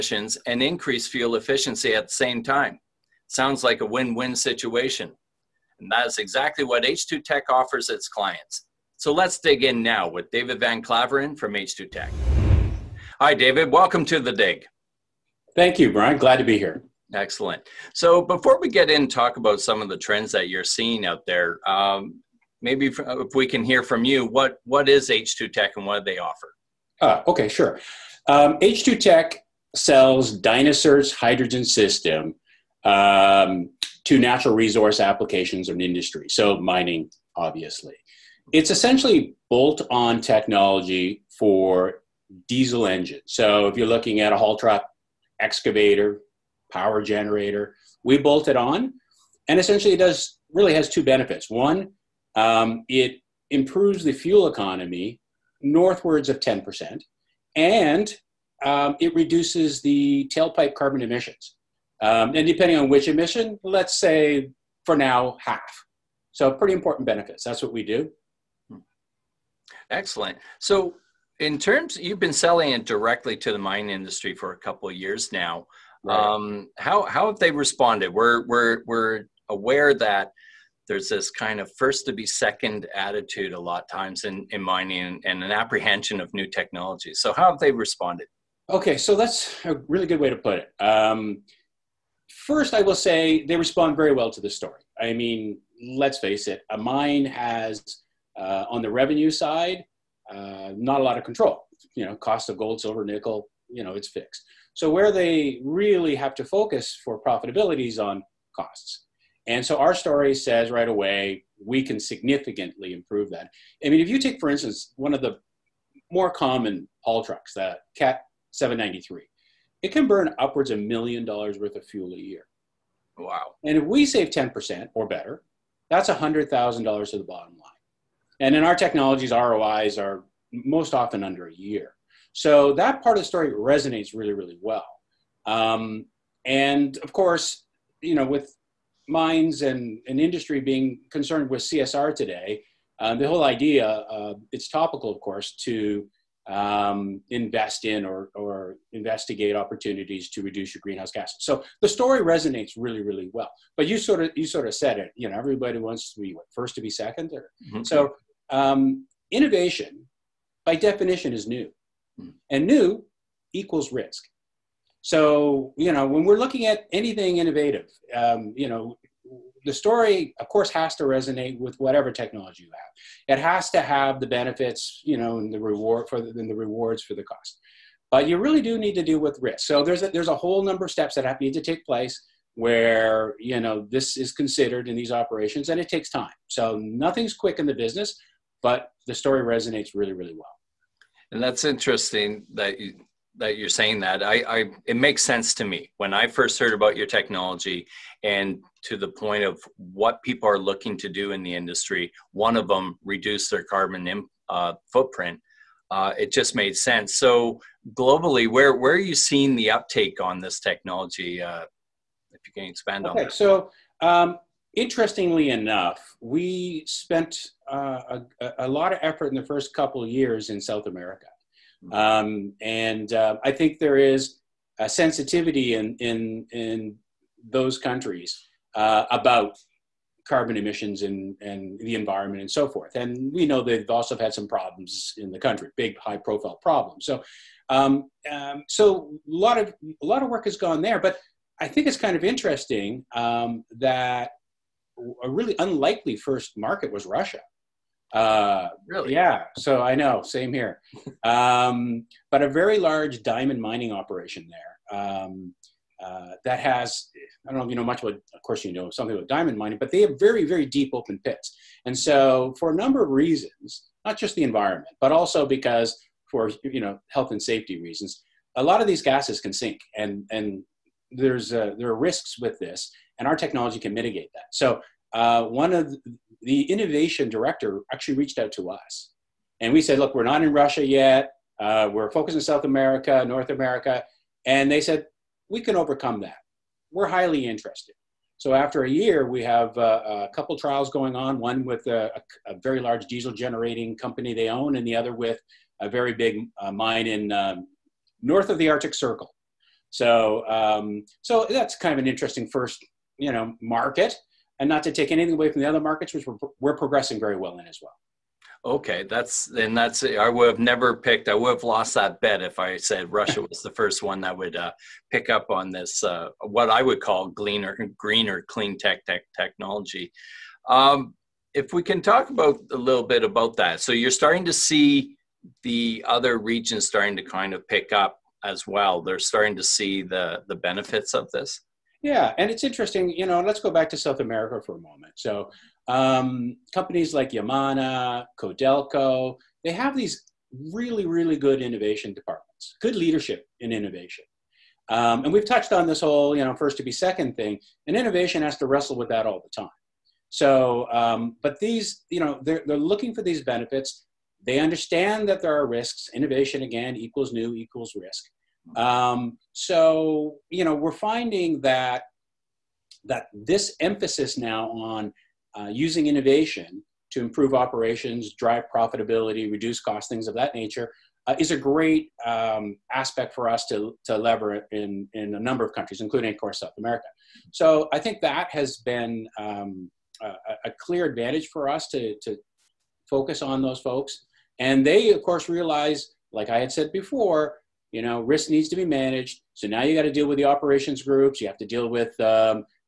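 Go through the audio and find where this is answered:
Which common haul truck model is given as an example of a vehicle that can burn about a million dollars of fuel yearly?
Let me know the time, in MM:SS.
01:57.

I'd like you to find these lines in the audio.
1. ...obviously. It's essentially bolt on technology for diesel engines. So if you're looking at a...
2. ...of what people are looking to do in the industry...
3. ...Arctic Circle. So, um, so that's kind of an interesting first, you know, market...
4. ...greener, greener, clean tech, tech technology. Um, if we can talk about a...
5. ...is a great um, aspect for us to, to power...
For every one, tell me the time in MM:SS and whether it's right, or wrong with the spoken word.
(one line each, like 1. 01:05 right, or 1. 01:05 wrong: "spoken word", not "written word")
1. 00:37 right
2. 03:19 right
3. 04:58 right
4. 05:17 right
5. 06:11 wrong: "lever", not "power".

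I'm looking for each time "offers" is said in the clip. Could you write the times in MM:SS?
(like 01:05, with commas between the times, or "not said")
00:07, 00:26.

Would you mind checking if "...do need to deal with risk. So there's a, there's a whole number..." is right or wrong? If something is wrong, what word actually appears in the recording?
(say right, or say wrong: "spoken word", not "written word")
right.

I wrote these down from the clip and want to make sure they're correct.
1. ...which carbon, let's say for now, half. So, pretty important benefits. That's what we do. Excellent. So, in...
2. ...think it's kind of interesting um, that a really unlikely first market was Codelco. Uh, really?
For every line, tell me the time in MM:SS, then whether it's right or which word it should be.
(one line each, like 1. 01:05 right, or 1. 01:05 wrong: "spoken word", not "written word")
1. 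01:02 wrong: "emission", not "carbon"
2. 04:01 wrong: "Russia", not "Codelco".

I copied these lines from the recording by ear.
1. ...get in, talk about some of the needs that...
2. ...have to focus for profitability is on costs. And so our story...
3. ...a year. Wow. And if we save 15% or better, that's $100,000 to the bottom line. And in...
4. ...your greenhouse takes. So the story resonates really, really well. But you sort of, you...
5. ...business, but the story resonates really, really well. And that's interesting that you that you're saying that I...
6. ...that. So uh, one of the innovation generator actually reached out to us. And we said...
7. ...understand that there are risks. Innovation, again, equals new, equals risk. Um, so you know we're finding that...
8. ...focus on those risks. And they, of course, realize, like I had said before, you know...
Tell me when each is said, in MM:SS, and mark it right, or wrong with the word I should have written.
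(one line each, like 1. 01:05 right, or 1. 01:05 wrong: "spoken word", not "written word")
1. 00:18 wrong: "trends", not "needs"
2. 01:46 right
3. 02:02 wrong: "10", not "15"
4. 02:30 wrong: "gases", not "takes"
5. 03:07 right
6. 04:34 wrong: "director", not "generator"
7. 05:54 right
8. 06:23 wrong: "folks", not "risks".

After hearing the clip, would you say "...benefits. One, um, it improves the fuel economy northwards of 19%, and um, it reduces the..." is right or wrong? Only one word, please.
wrong.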